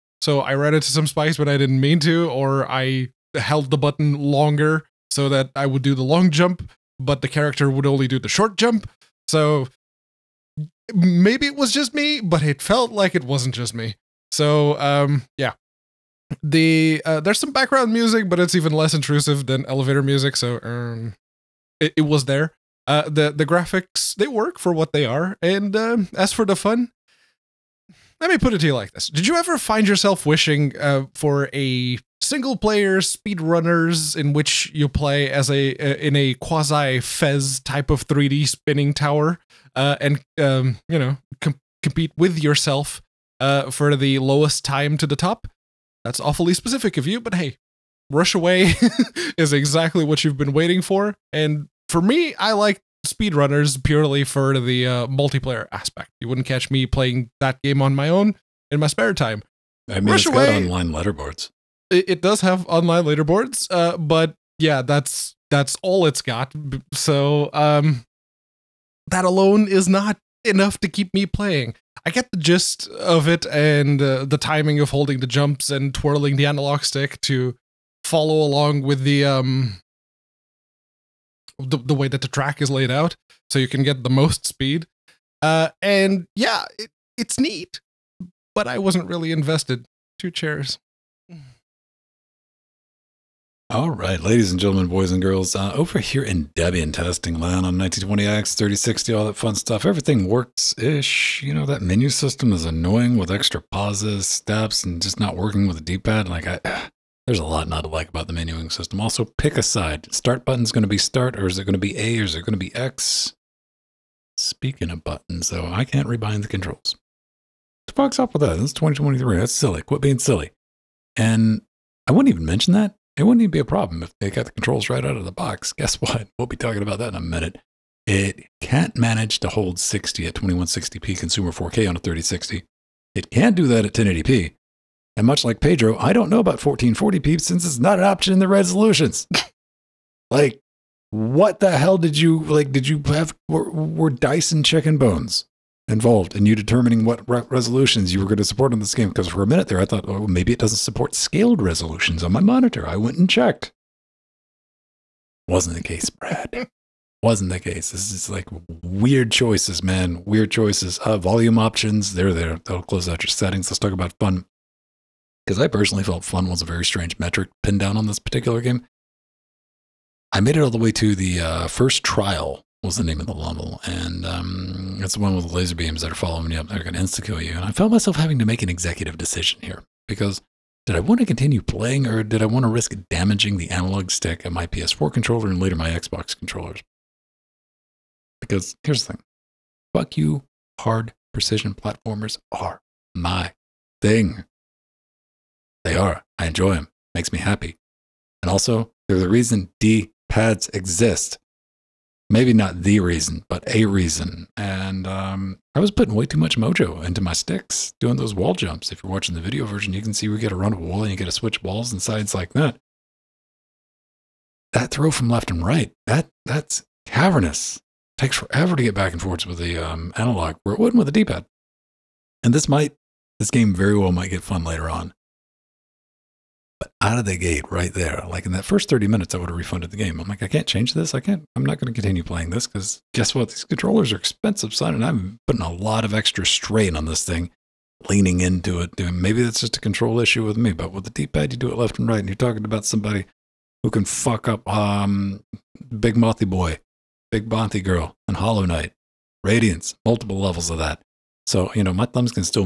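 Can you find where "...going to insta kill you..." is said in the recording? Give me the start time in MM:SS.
02:56.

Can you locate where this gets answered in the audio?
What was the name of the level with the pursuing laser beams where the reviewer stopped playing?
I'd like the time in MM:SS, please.
02:51.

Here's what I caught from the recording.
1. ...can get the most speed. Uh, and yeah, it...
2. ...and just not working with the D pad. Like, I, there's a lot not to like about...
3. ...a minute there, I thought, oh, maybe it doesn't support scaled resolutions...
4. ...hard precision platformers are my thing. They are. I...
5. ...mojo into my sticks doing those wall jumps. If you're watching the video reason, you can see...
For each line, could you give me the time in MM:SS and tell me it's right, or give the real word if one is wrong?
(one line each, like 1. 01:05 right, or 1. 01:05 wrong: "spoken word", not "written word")
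1. 01:23 right
2. 01:44 right
3. 02:29 right
4. 03:10 right
5. 03:26 wrong: "version", not "reason".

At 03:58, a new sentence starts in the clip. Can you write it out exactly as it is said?
Doing, maybe that's just a control issue with me, but with the D pad, you do it left and right.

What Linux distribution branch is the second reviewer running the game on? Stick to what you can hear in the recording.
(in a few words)
Debian testing.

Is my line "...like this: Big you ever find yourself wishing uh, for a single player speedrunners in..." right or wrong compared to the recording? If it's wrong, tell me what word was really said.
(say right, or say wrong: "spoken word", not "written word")
wrong: "Did", not "Big".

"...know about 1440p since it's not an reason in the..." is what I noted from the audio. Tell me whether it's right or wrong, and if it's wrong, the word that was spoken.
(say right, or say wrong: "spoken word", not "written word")
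wrong: "option", not "reason".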